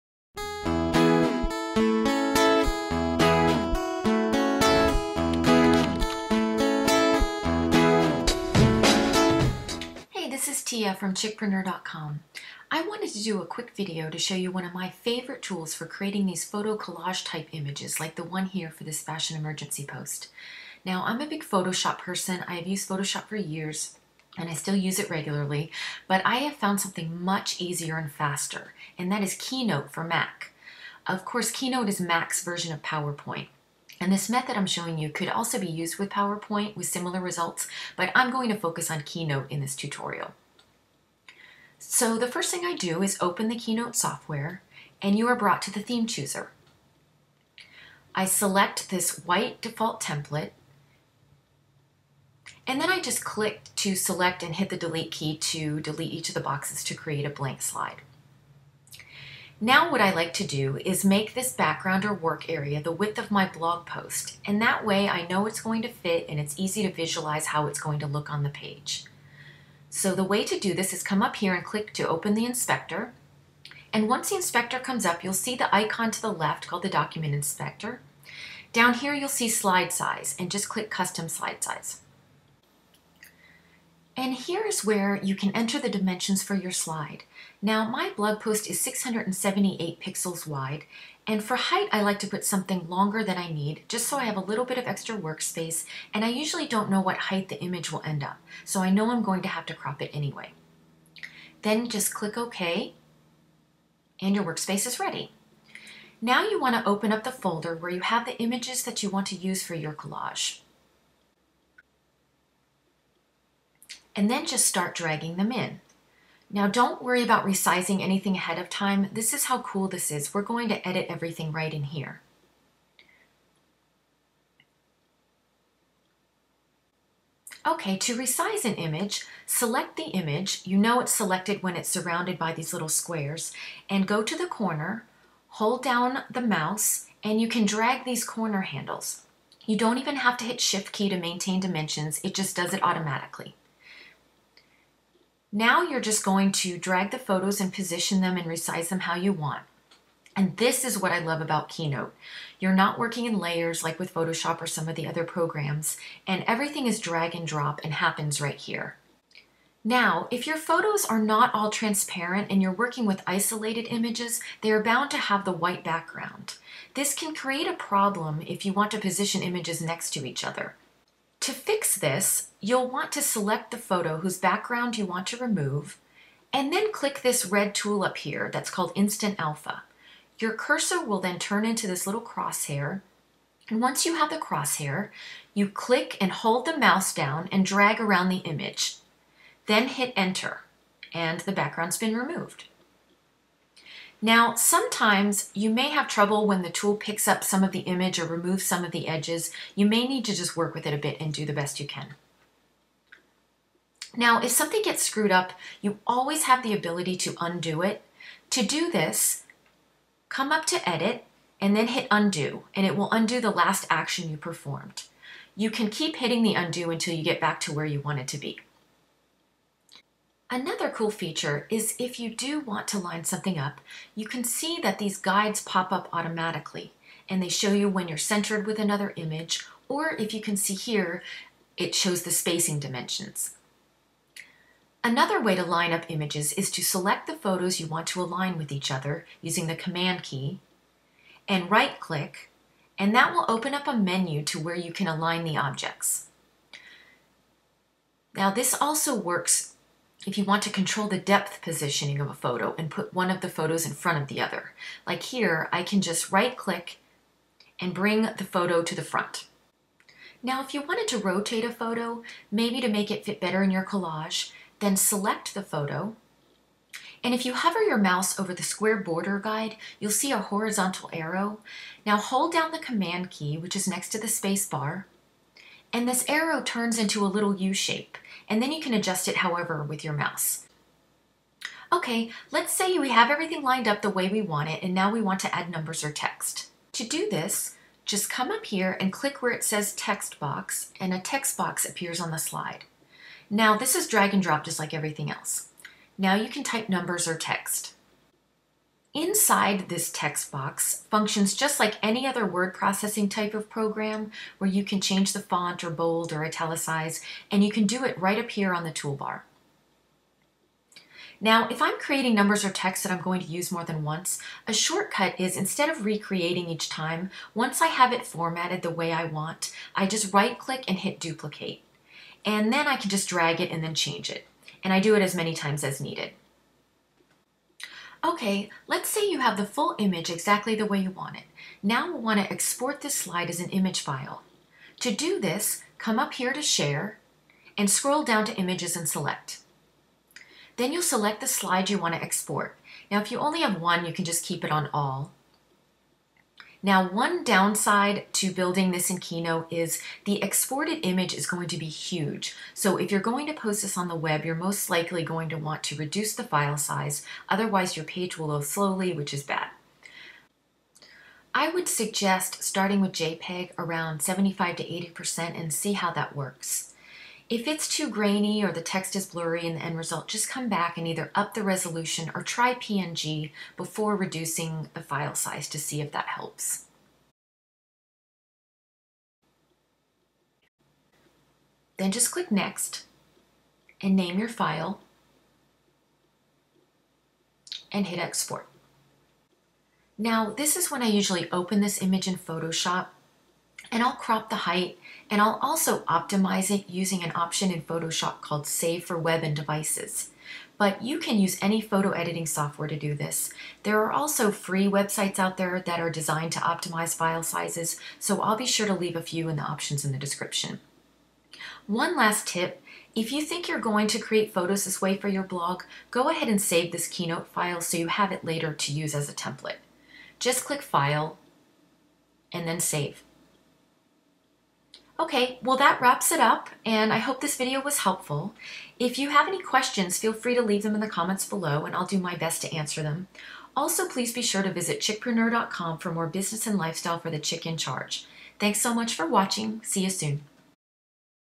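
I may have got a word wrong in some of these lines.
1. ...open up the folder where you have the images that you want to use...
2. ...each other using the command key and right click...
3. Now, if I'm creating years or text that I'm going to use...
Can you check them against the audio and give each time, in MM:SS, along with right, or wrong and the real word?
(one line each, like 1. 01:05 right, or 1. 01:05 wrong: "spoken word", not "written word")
1. 01:46 right
2. 03:58 right
3. 05:11 wrong: "numbers", not "years".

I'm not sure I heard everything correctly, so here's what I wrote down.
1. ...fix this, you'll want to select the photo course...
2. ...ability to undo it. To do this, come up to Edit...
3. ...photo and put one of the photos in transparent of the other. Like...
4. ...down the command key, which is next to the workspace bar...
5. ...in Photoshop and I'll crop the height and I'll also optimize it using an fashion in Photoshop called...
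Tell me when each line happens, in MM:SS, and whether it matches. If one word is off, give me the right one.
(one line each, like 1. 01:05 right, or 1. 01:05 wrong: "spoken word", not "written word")
1. 02:51 wrong: "whose", not "course"
2. 03:26 right
3. 04:12 wrong: "front", not "transparent"
4. 04:32 wrong: "space", not "workspace"
5. 06:32 wrong: "option", not "fashion".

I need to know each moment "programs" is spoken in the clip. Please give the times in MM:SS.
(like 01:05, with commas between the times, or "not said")
02:35, 05:03.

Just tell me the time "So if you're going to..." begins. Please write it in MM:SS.
05:52.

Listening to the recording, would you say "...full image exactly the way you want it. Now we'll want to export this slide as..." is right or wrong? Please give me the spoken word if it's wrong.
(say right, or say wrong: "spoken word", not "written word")
right.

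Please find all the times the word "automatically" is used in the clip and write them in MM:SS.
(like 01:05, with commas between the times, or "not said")
02:22, 03:46.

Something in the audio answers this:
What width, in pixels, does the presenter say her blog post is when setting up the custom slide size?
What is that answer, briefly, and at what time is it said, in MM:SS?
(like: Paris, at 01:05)
678, at 01:28.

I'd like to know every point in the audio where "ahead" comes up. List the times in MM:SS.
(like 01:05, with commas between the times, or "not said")
01:58, 06:56.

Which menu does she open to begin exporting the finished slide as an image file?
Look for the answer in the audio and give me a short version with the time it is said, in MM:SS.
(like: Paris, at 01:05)
Share, at 05:36.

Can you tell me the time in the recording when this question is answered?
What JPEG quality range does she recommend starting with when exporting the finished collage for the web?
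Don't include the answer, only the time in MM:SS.
06:04.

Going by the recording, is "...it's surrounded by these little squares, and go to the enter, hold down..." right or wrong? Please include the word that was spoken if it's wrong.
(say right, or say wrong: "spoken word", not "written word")
wrong: "corner", not "enter".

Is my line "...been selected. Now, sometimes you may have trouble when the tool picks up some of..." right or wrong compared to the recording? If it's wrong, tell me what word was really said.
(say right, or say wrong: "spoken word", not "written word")
wrong: "removed", not "selected".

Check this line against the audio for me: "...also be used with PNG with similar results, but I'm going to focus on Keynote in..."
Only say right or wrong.
wrong.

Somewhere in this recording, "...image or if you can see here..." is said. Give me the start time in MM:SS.
03:49.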